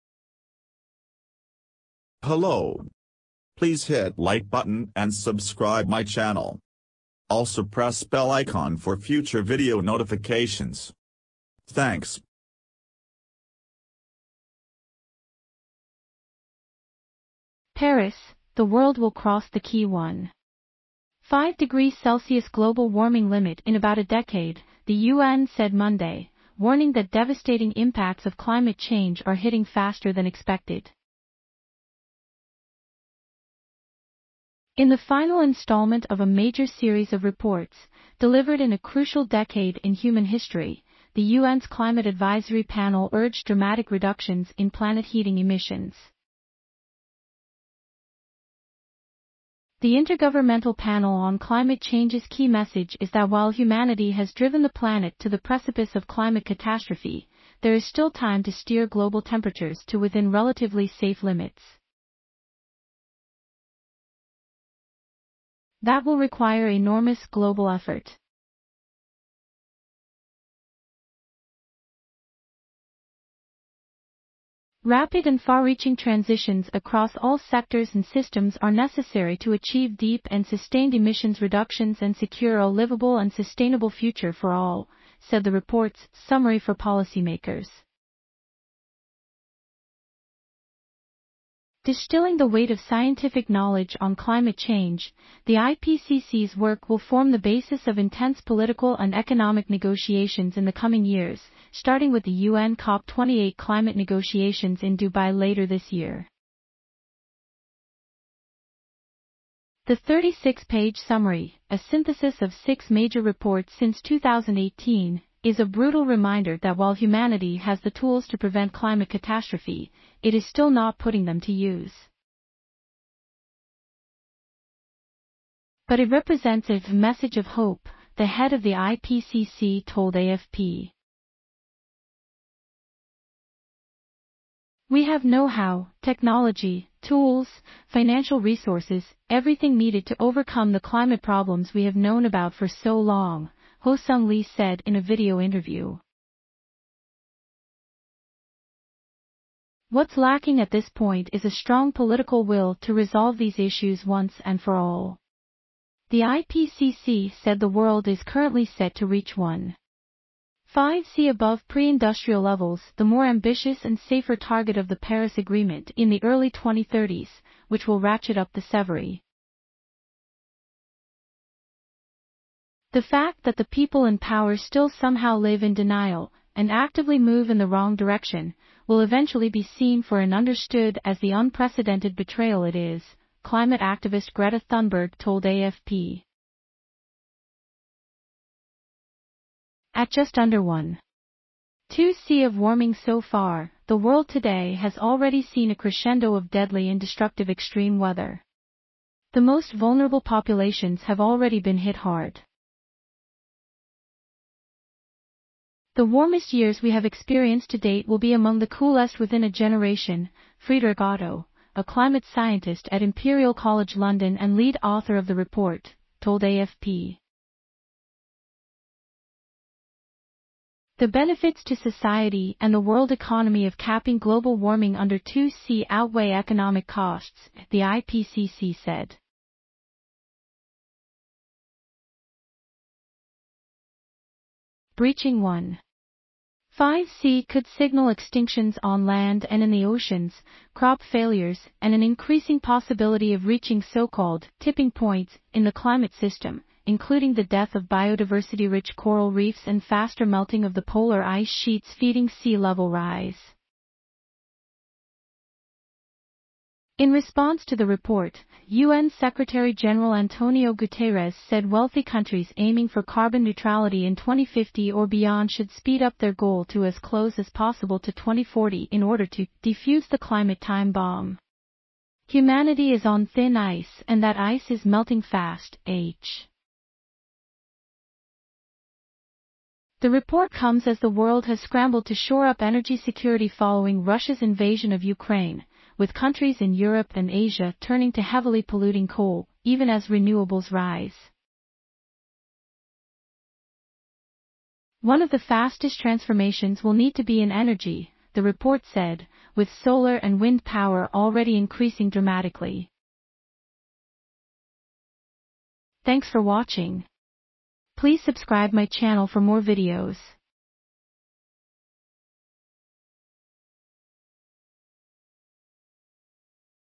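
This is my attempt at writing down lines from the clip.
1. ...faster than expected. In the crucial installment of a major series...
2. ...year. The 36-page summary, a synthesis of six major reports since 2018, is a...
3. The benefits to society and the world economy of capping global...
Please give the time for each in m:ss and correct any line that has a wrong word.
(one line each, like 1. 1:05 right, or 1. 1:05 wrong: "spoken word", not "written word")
1. 0:29 wrong: "final", not "crucial"
2. 1:45 right
3. 3:40 right.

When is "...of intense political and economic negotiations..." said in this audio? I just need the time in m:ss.
1:37.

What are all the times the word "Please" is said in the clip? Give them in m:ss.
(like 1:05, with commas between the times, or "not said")
0:03, 5:07.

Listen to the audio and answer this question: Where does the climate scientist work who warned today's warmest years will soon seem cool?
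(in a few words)
Imperial College London.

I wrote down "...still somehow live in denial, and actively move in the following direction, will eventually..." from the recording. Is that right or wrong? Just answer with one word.
wrong.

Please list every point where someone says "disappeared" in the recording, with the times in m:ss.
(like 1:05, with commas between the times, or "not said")
not said.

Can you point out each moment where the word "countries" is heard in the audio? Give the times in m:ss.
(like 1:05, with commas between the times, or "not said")
4:22, 4:46.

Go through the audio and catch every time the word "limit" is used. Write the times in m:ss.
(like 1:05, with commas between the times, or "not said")
0:23, 1:01.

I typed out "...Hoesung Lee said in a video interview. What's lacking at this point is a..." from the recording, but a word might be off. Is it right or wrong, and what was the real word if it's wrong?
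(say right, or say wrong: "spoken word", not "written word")
right.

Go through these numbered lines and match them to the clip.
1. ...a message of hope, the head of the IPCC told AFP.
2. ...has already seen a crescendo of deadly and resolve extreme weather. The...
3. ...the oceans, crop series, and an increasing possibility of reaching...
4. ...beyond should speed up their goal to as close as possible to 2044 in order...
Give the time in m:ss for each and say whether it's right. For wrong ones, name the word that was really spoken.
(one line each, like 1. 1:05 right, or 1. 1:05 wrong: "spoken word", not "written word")
1. 2:06 right
2. 3:14 wrong: "destructive", not "resolve"
3. 3:59 wrong: "failures", not "series"
4. 4:25 wrong: "2040", not "2044".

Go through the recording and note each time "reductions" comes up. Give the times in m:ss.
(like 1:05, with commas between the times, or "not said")
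0:43, 1:21.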